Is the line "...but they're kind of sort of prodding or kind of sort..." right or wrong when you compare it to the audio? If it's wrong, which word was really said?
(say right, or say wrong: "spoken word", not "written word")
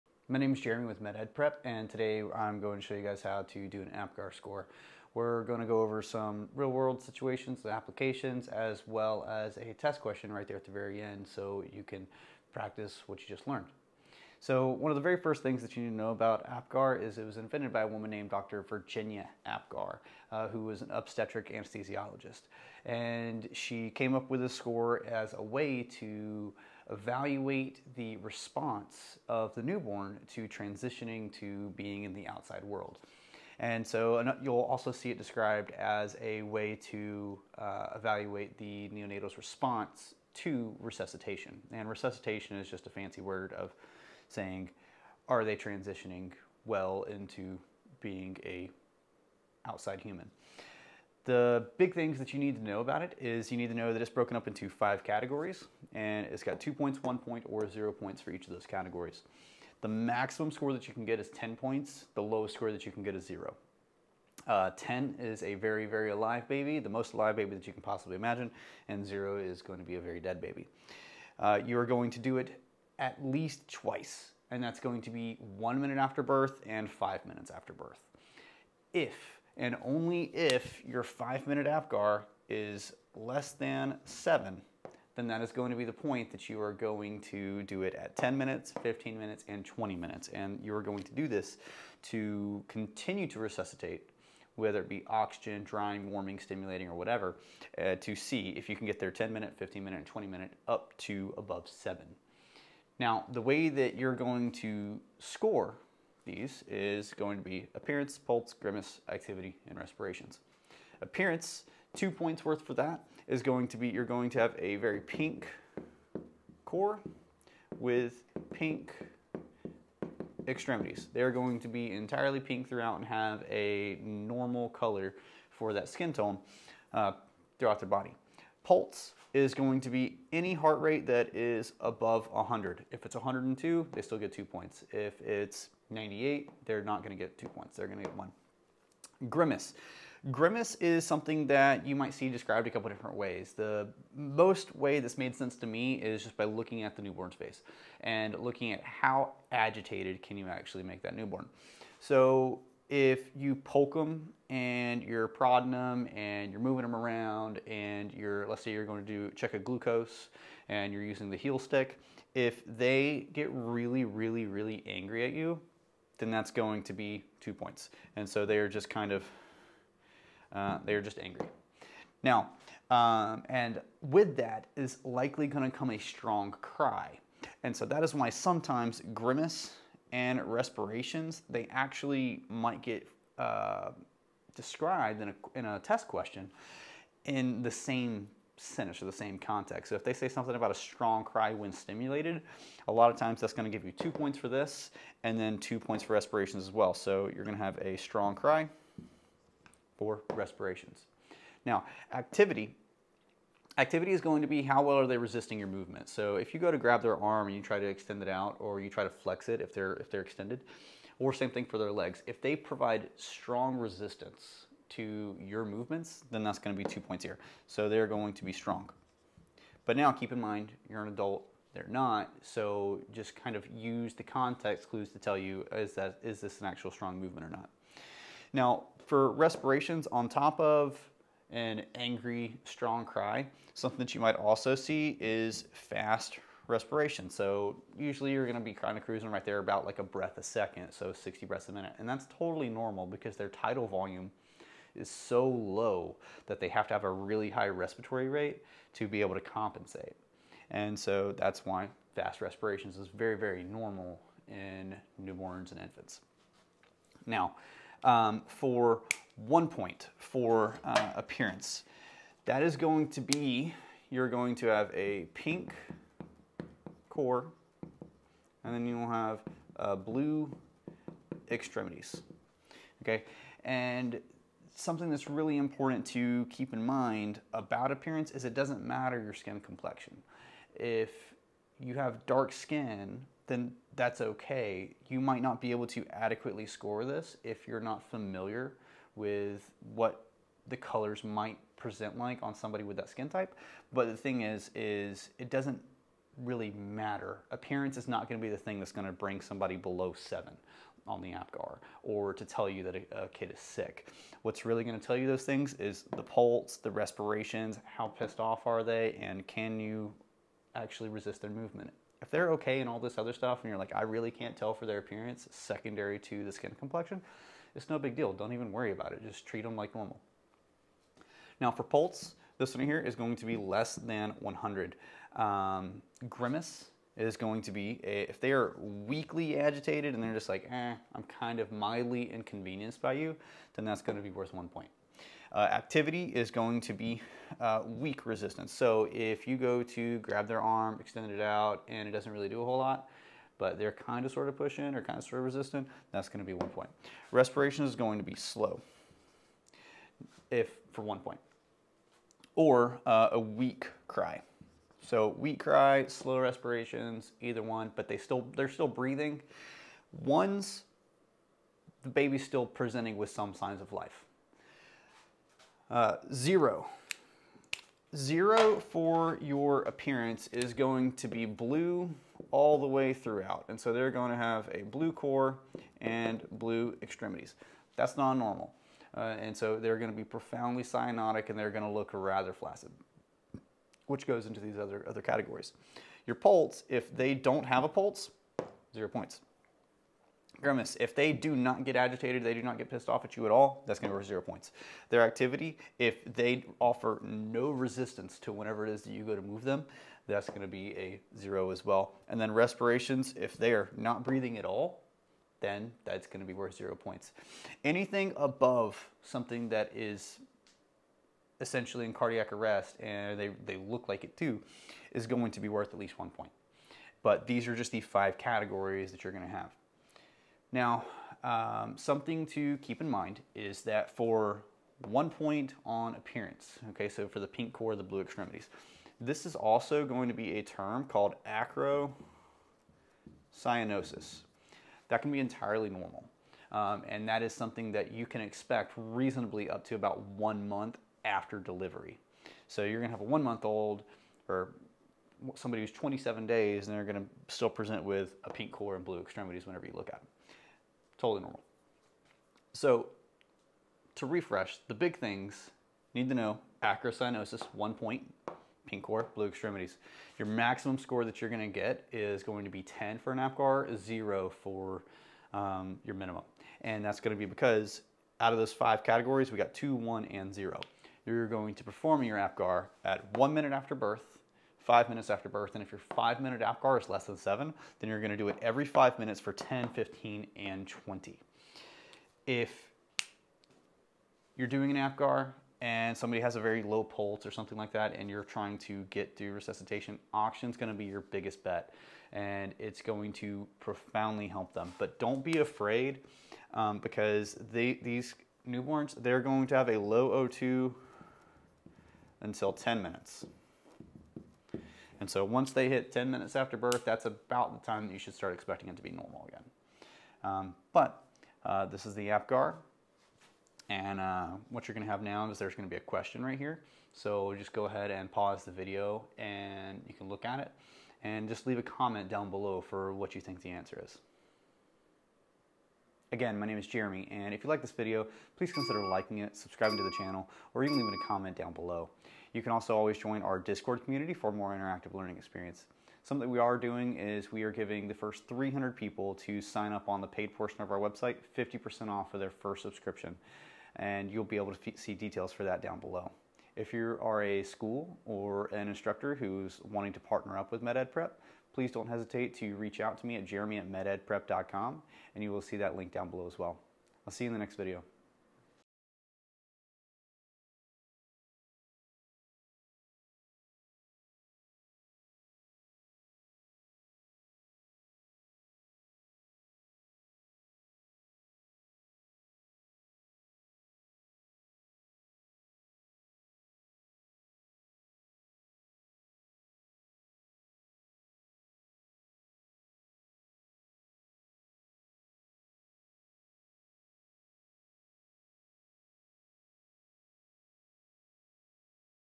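wrong: "pushing", not "prodding".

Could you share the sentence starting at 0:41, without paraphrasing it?
And resuscitation is just a fancy word of saying, are they transitioning well into being a outside human?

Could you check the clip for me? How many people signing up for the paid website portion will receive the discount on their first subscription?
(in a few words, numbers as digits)
300.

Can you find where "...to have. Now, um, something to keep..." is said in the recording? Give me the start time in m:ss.
6:59.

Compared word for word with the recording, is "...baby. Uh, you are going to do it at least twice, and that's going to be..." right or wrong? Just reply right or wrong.
right.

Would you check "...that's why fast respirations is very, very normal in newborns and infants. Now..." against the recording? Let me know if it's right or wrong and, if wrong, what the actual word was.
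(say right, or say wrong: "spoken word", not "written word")
right.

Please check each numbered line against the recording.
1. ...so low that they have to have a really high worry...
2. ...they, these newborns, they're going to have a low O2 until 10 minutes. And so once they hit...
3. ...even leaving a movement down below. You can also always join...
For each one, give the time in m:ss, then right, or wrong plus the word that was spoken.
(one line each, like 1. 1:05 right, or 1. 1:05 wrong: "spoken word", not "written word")
1. 4:05 wrong: "respiratory", not "worry"
2. 8:17 right
3. 8:50 wrong: "comment", not "movement".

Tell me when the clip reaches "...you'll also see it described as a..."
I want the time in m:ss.
0:34.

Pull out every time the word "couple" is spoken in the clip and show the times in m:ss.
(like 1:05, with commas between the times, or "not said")
2:22.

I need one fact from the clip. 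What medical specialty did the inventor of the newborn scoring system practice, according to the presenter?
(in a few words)
Obstetric anesthesiologist.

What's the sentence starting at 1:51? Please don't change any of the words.
Appearance, two points worth for that, is going to be you're going to have a very pink core with pink extremities.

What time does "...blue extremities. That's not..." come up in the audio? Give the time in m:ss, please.
6:16.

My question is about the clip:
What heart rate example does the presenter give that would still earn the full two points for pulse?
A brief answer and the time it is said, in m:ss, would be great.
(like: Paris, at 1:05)
102, at 2:13.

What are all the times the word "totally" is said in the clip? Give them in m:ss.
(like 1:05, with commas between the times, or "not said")
4:02, 7:31.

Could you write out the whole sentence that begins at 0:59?
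The maximum score that you can get is 10 points.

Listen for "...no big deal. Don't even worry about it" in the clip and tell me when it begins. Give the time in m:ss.
5:17.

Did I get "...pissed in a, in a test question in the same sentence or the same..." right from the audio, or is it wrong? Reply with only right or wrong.
wrong.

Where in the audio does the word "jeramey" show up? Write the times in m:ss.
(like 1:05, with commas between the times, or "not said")
0:00, 8:46, 9:13.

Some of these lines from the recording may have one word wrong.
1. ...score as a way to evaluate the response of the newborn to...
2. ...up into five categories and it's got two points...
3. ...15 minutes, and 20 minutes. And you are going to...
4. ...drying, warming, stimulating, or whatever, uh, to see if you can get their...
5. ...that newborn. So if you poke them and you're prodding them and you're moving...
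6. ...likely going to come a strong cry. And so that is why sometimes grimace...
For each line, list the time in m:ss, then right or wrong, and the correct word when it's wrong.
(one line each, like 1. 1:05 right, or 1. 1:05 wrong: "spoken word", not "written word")
1. 0:24 right
2. 0:54 right
3. 1:28 right
4. 1:35 right
5. 2:31 right
6. 2:55 right.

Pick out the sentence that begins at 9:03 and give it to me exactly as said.
And you'll be able to see details for that down below.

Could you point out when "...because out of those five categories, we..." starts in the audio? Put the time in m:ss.
7:47.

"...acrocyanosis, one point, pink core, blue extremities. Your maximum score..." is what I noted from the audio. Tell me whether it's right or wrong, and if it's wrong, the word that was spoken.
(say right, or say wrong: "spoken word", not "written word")
right.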